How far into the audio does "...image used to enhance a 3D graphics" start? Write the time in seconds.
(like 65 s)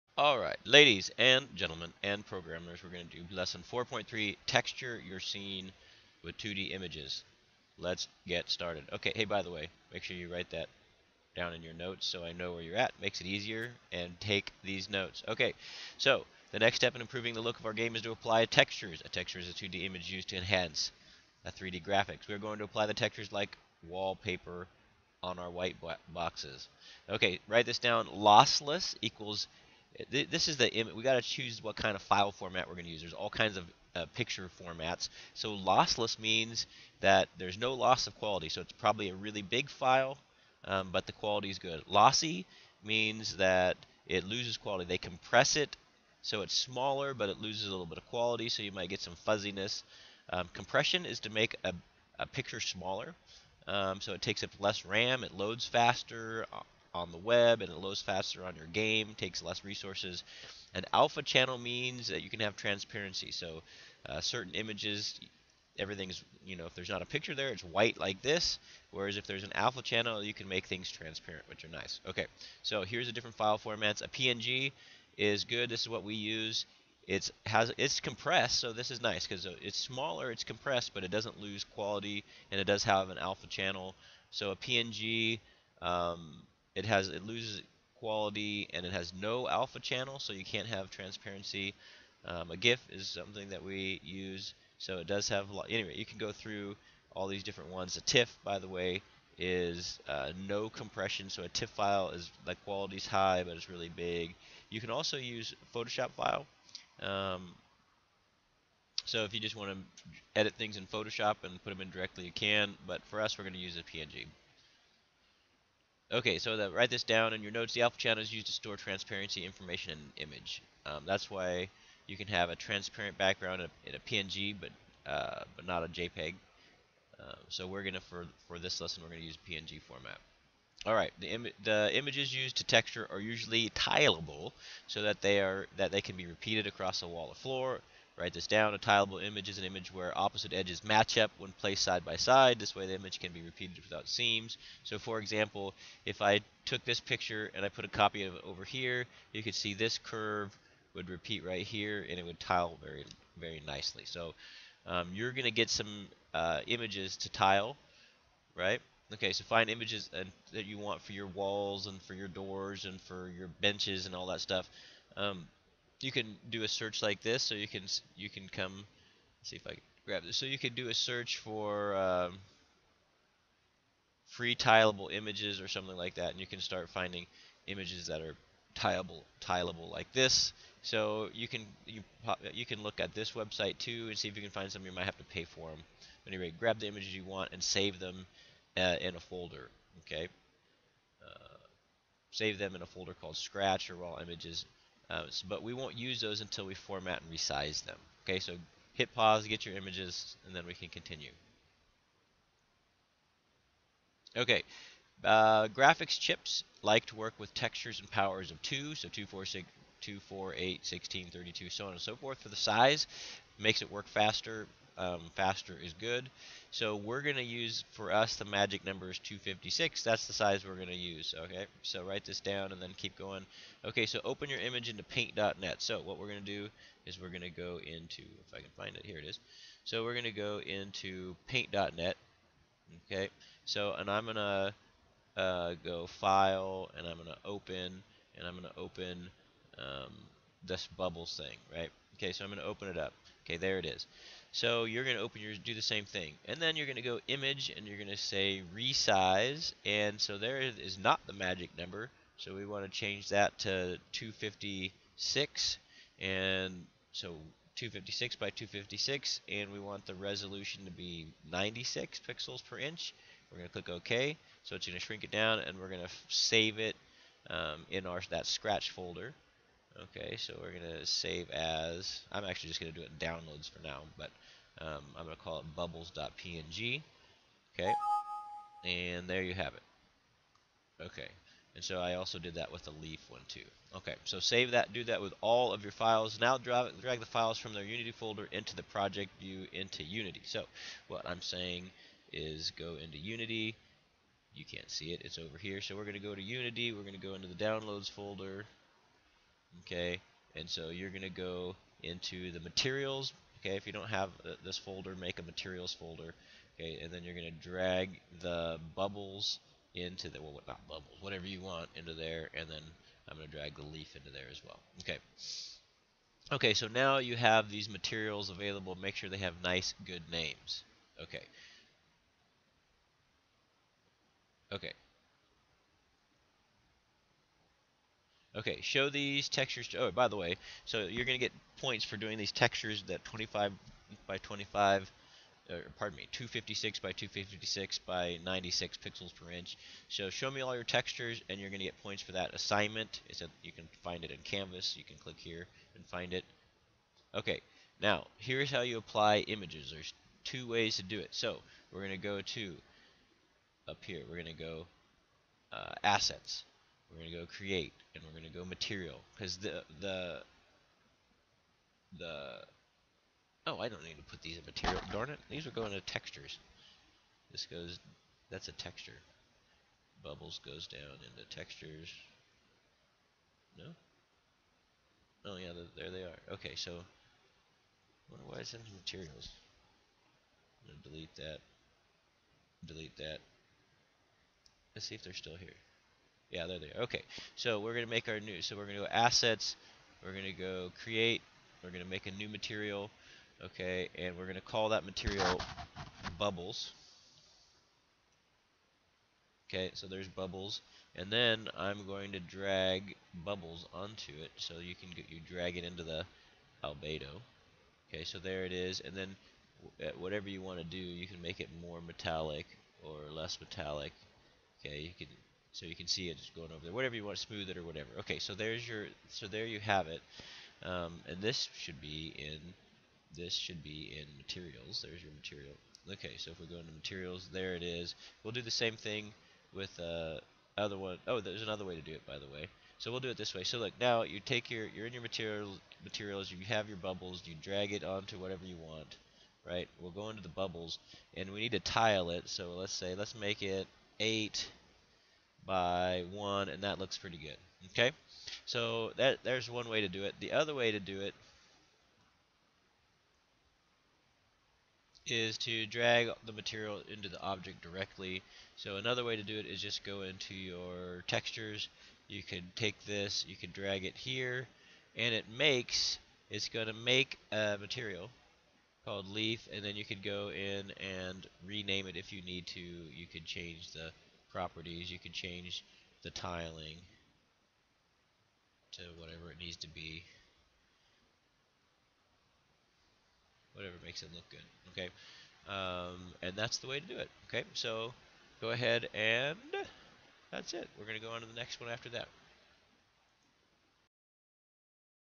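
19 s.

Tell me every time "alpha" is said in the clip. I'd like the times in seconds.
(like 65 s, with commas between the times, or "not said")
60 s, 69 s, 83 s, 89 s, 117 s.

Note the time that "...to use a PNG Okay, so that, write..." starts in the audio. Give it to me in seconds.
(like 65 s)
113 s.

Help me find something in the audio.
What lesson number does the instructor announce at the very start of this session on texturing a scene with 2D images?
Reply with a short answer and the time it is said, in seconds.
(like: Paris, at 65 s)
4.3, at 3 s.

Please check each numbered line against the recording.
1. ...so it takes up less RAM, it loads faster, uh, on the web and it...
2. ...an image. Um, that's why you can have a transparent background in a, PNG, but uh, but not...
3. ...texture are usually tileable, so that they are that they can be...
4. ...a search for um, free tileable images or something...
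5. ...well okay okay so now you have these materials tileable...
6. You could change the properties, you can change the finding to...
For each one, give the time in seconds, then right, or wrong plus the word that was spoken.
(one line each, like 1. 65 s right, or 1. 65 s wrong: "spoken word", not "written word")
1. 54 s right
2. 119 s right
3. 132 s right
4. 170 s right
5. 314 s wrong: "available", not "tileable"
6. 472 s wrong: "tiling", not "finding".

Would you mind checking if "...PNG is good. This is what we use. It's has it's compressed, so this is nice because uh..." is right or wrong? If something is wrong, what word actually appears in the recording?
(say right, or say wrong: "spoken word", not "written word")
right.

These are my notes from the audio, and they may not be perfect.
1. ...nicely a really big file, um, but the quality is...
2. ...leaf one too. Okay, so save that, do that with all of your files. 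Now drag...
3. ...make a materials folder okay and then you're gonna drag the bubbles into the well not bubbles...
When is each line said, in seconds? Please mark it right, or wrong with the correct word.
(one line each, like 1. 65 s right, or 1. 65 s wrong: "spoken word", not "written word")
1. 38 s wrong: "probably", not "nicely"
2. 282 s right
3. 305 s right.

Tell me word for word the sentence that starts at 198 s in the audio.
Okay, so hit pause, get your images, and then we can continue.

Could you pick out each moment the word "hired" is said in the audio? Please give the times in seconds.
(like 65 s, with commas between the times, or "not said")
not said.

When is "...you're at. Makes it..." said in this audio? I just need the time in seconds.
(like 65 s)
12 s.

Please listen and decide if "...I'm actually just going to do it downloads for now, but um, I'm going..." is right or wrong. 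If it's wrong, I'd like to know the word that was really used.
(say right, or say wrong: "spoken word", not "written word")
right.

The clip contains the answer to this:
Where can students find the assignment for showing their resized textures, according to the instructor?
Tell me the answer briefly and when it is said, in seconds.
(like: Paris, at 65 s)
Canvas, at 344 s.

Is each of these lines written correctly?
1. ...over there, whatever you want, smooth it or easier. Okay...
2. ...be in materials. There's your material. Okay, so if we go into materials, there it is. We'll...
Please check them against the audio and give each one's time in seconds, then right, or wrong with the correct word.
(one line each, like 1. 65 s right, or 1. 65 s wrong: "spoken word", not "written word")
1. 416 s wrong: "whatever", not "easier"
2. 423 s right.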